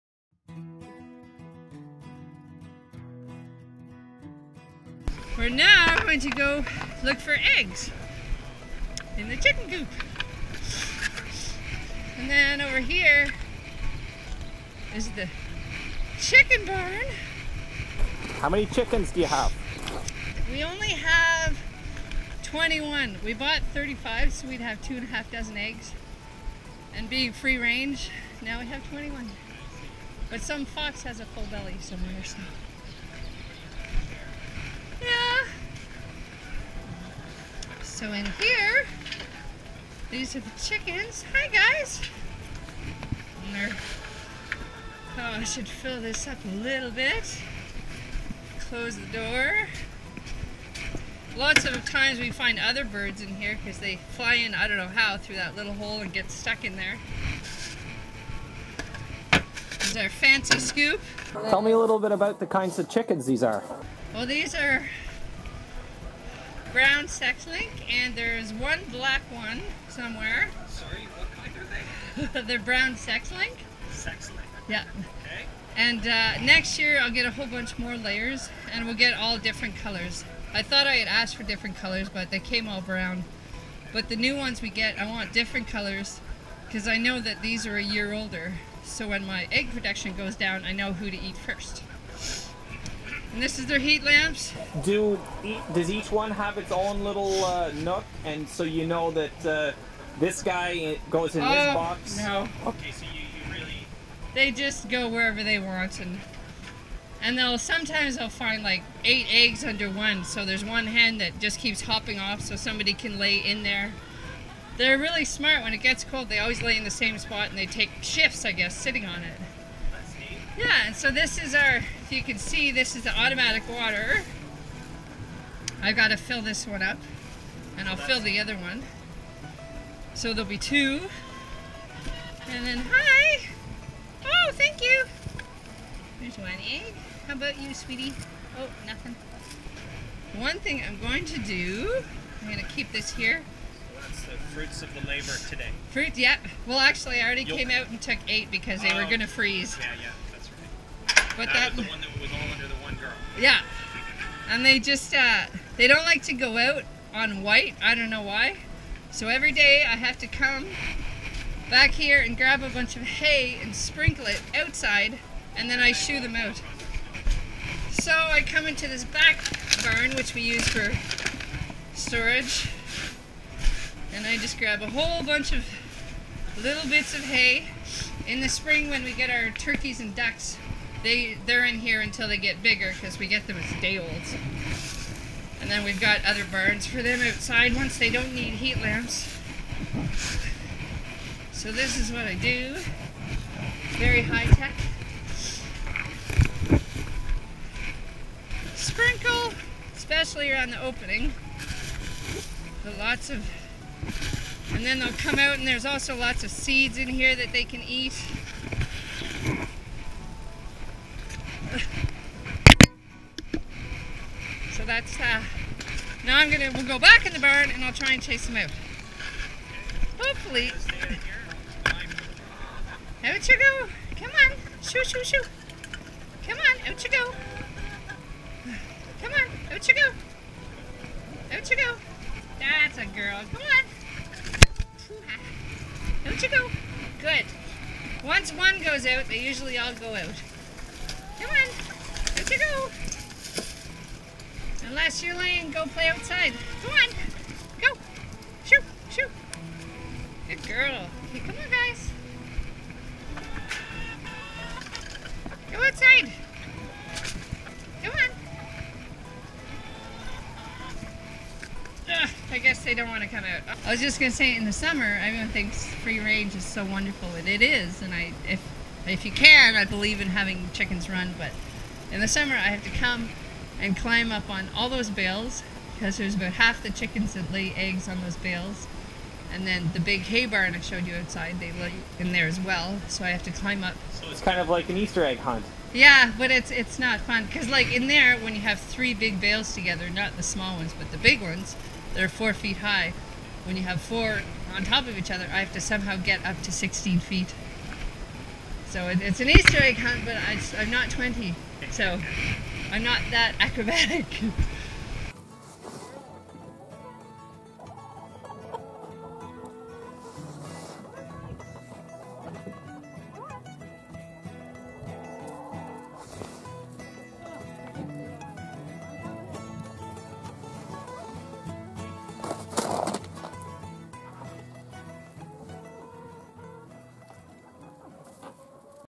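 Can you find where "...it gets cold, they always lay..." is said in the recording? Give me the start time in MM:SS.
01:55.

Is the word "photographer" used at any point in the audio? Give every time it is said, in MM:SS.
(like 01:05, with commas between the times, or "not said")
not said.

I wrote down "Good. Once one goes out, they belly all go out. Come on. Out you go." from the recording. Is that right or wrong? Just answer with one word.
wrong.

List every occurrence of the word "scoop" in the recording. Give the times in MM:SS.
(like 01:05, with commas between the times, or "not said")
01:00.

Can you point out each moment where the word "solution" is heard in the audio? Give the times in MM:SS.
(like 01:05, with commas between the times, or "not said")
not said.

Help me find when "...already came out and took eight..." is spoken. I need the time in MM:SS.
02:27.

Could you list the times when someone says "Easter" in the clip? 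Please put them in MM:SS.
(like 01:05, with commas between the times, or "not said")
04:44, 04:59.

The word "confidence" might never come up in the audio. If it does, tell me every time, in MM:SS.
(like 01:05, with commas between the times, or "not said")
not said.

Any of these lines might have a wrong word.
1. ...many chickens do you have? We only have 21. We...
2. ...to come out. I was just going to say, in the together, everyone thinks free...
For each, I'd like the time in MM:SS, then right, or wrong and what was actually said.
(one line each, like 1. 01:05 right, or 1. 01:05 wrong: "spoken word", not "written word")
1. 00:18 right
2. 04:23 wrong: "summer", not "together".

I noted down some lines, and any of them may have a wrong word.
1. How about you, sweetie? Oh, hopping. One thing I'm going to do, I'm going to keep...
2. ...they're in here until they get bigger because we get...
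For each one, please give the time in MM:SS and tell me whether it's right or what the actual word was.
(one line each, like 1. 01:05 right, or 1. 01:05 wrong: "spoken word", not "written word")
1. 02:17 wrong: "nothing", not "hopping"
2. 03:01 right.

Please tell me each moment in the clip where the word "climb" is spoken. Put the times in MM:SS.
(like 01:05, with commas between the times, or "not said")
04:33, 04:43.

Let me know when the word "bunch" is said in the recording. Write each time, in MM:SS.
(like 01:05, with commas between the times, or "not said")
01:17, 02:42, 02:55.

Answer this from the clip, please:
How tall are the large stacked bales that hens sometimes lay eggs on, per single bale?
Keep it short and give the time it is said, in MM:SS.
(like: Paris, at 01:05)
4 feet, at 04:52.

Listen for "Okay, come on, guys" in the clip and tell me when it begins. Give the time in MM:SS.
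04:11.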